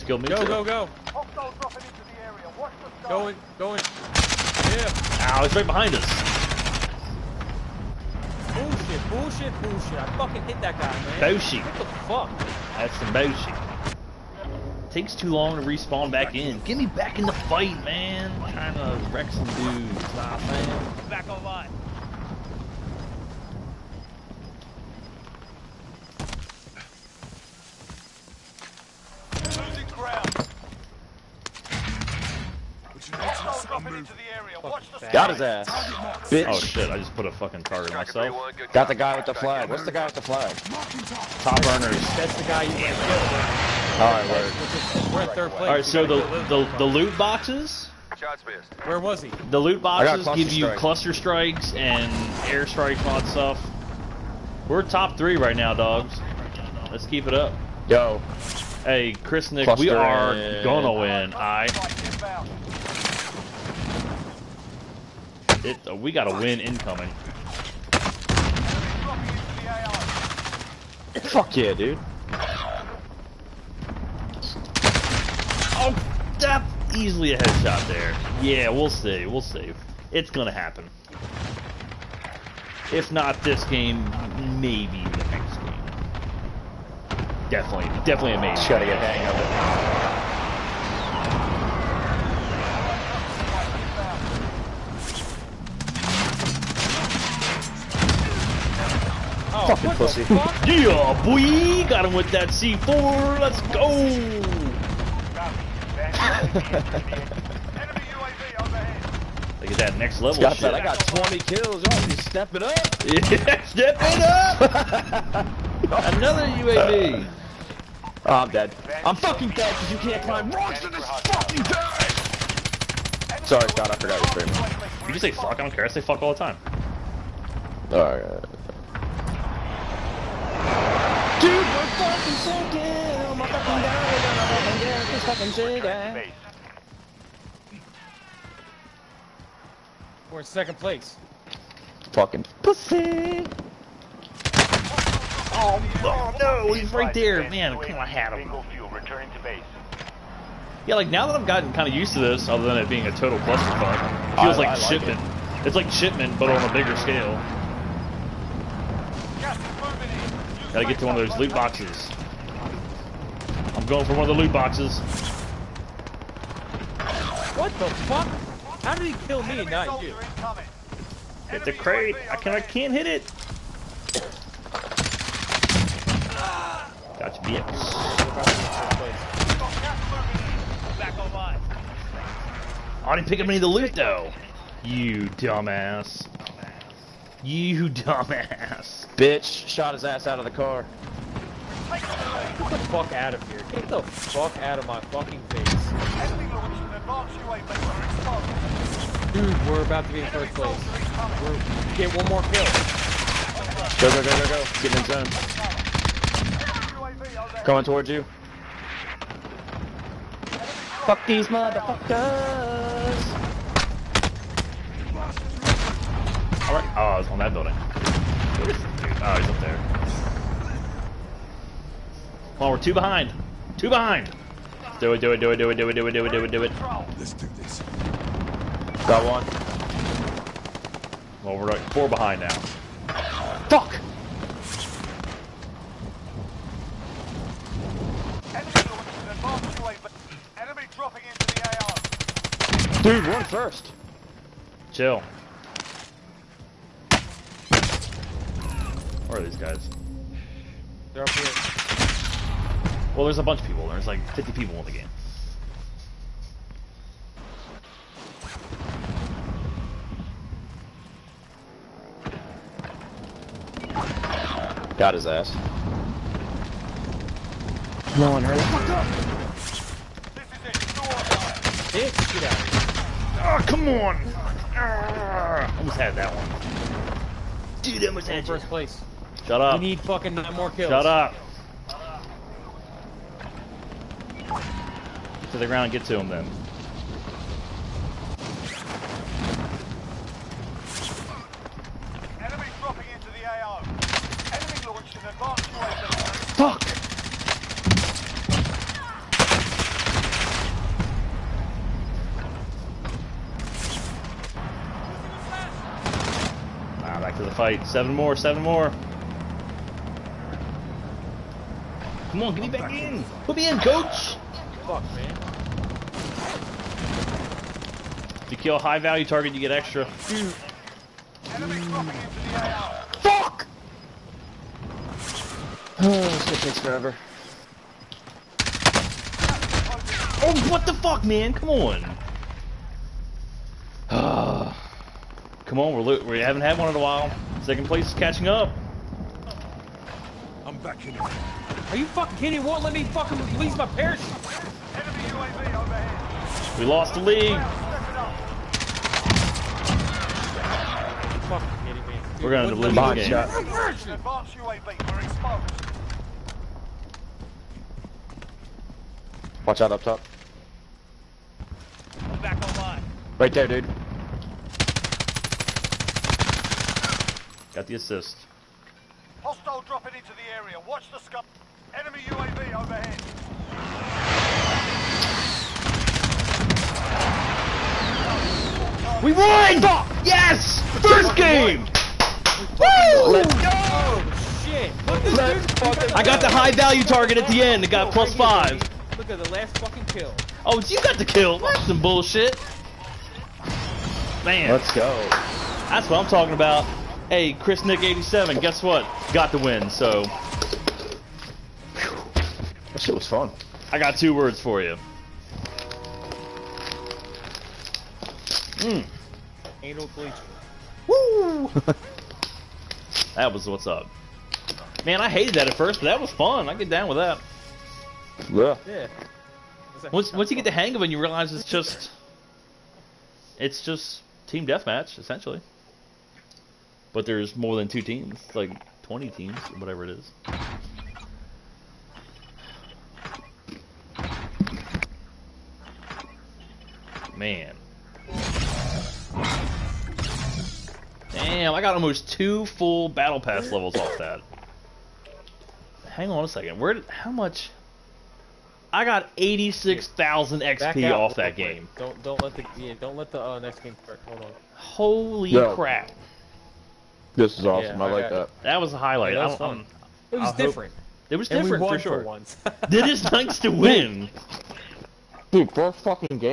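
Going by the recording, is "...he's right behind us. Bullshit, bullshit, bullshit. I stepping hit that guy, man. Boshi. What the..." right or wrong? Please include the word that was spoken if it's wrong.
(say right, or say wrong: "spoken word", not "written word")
wrong: "fucking", not "stepping".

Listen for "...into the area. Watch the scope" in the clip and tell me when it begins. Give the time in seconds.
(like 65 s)
370 s.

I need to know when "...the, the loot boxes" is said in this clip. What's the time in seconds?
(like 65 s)
46 s.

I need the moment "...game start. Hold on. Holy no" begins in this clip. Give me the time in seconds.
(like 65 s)
453 s.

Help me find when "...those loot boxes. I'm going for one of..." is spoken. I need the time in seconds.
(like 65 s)
161 s.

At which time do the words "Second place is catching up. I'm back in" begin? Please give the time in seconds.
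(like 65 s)
337 s.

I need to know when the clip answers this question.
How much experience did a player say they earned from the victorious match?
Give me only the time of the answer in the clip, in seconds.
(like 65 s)
449 s.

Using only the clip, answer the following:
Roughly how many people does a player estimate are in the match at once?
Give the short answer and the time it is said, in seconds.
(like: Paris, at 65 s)
50, at 254 s.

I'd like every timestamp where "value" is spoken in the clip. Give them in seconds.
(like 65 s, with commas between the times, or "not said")
318 s, 386 s.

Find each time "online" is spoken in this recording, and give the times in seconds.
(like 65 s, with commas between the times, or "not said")
21 s, 362 s.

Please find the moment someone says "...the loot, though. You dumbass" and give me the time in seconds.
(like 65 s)
183 s.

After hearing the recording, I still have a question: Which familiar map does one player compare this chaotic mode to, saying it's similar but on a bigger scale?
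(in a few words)
Shipment.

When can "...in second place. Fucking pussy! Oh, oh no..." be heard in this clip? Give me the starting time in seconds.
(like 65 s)
140 s.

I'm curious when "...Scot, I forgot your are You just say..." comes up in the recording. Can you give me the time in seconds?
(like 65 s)
123 s.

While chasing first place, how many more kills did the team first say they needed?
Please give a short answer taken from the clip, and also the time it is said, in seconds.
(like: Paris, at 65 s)
9, at 280 s.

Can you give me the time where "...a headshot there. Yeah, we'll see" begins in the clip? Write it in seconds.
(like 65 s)
77 s.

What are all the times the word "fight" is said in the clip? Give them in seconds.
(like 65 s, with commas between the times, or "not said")
17 s, 307 s.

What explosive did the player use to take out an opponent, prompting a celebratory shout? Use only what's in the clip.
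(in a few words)
C4.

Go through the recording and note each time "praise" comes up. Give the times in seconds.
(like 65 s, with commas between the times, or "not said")
not said.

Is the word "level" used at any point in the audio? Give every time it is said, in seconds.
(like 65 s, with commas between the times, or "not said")
110 s, 443 s.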